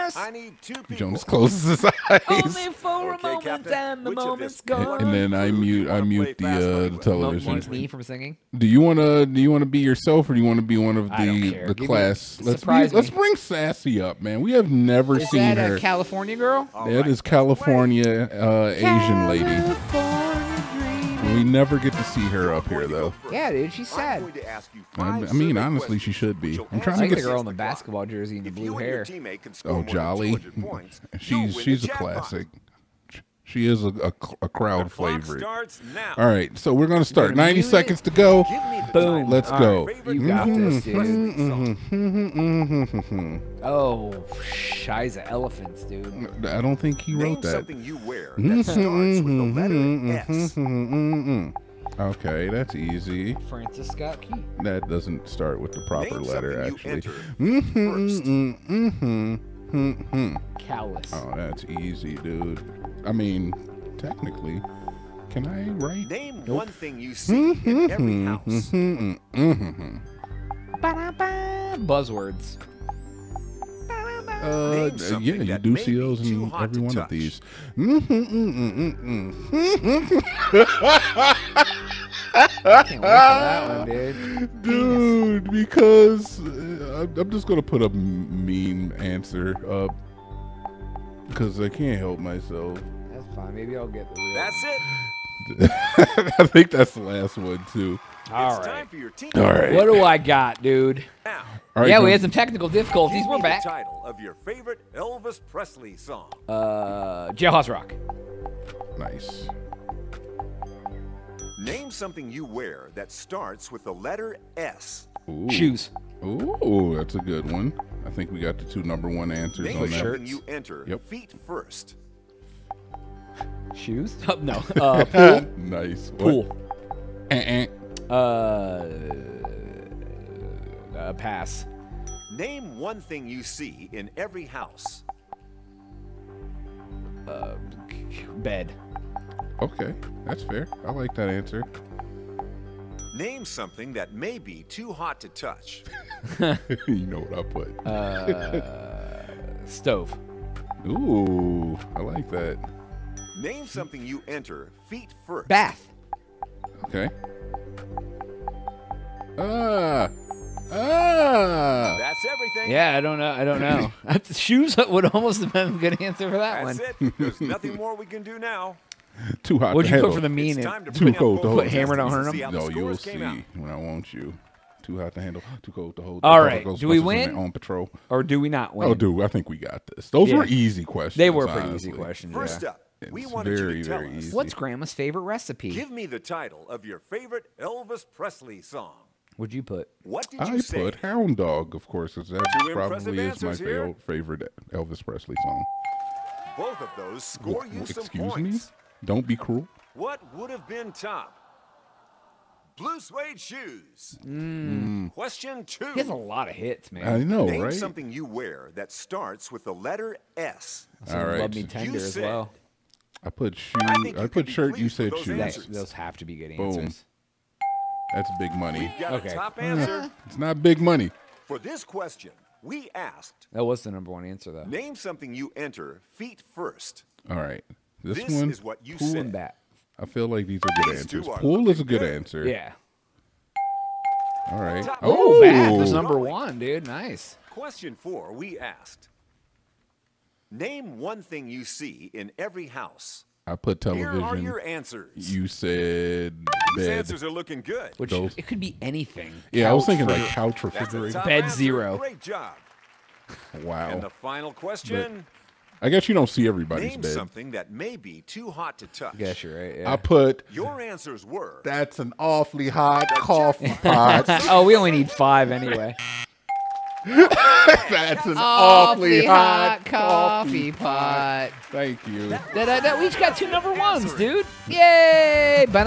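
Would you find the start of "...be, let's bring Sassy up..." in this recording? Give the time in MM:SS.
00:12.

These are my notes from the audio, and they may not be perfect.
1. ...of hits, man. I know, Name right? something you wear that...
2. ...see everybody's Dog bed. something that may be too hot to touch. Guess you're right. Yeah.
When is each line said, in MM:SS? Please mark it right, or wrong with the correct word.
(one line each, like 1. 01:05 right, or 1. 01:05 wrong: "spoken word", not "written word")
1. 03:26 right
2. 04:16 wrong: "Name", not "Dog".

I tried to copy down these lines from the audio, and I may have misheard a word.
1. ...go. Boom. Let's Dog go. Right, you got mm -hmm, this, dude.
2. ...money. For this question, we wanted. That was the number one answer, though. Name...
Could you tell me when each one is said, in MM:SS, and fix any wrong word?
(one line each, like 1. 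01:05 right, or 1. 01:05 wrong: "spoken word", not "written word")
1. 00:38 wrong: "All", not "Dog"
2. 03:40 wrong: "asked", not "wanted".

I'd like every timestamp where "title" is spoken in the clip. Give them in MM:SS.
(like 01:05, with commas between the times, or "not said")
01:43, 03:06.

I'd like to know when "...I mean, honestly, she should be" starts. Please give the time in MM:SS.
00:25.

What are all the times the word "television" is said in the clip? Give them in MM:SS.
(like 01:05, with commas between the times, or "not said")
00:07, 04:03.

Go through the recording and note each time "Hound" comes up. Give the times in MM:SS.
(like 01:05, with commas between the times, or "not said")
03:10.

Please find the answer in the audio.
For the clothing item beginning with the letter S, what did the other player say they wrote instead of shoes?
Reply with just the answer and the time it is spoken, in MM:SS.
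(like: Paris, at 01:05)
Shirt, at 03:34.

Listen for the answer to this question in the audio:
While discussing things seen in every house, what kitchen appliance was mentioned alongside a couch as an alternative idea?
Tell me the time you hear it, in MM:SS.
04:10.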